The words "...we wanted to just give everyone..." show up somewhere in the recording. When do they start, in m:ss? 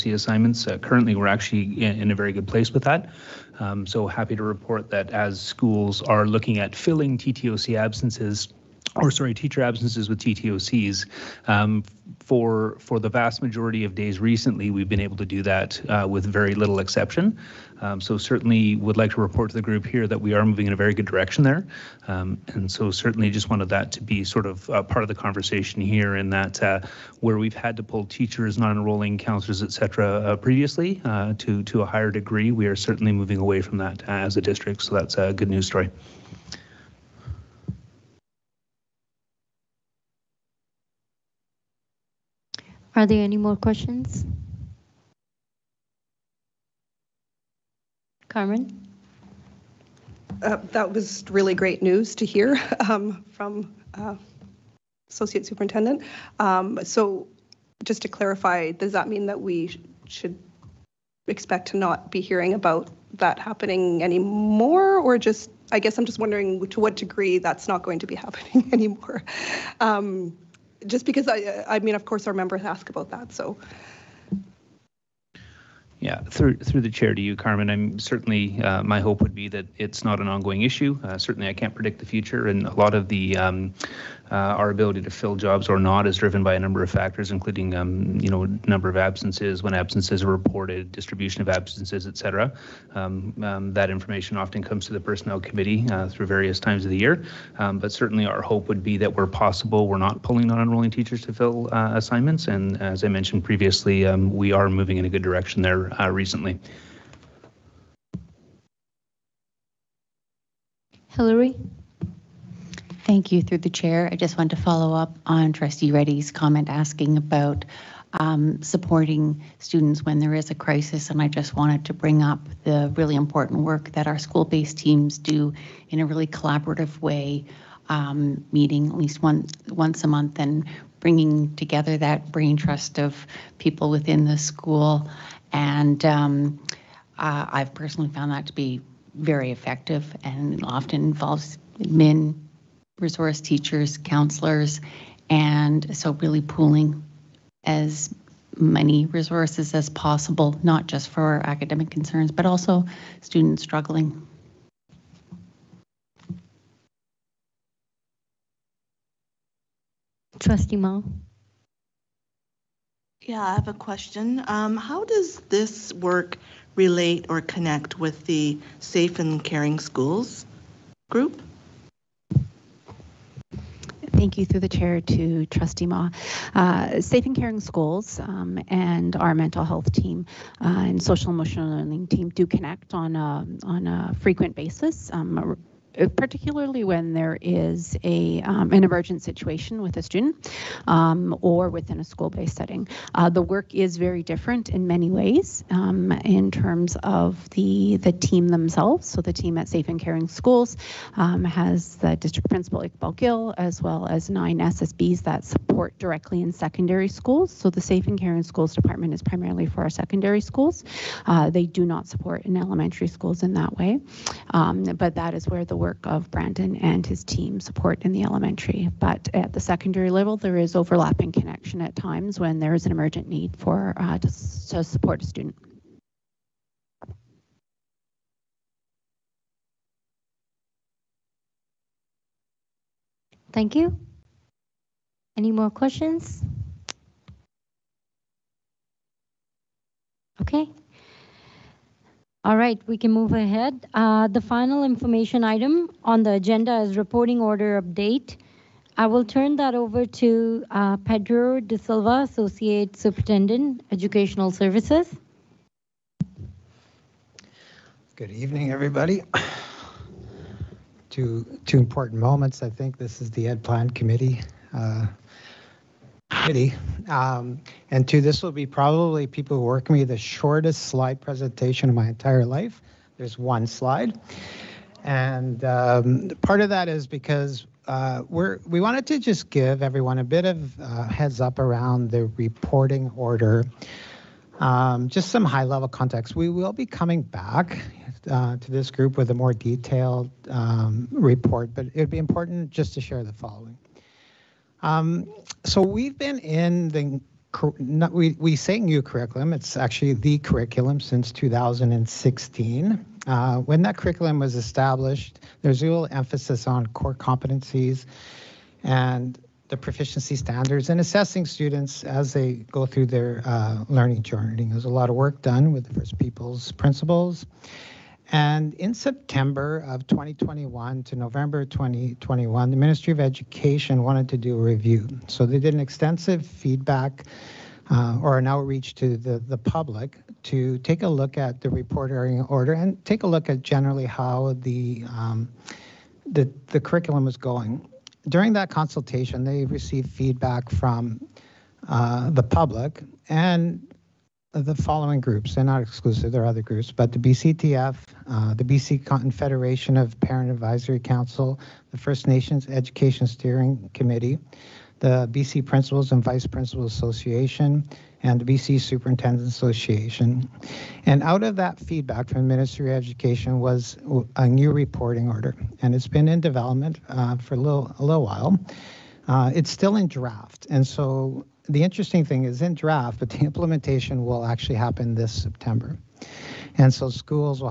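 4:38.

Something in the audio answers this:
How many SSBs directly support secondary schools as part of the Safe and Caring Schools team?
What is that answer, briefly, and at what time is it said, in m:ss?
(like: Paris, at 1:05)
9, at 3:24.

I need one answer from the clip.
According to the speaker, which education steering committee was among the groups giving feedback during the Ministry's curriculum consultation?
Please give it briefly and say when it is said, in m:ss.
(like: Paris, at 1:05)
First Nations Education Steering Committee, at 5:51.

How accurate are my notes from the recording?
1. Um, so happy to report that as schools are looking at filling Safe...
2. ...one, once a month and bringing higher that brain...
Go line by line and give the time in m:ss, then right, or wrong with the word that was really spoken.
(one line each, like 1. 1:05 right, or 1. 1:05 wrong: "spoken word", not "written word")
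1. 0:03 wrong: "TTOC", not "Safe"
2. 2:09 wrong: "together", not "higher".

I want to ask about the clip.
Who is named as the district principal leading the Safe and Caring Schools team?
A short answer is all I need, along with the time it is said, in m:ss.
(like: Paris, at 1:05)
Iqbal Gill, at 3:22.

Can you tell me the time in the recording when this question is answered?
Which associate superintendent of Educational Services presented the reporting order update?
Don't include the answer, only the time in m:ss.
4:10.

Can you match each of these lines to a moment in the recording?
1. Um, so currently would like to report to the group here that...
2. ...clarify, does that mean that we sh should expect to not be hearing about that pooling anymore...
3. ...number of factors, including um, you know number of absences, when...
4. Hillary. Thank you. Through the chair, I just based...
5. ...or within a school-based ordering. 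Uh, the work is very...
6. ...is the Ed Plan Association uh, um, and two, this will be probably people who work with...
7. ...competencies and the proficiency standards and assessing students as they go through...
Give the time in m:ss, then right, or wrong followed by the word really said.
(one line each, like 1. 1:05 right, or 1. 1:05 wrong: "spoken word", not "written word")
1. 0:17 wrong: "certainly", not "currently"
2. 0:58 wrong: "happening", not "pooling"
3. 1:26 right
4. 1:51 wrong: "wanted", not "based"
5. 3:11 wrong: "setting", not "ordering"
6. 4:23 wrong: "Committee", not "Association"
7. 5:07 right.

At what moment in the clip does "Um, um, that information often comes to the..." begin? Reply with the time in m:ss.
1:32.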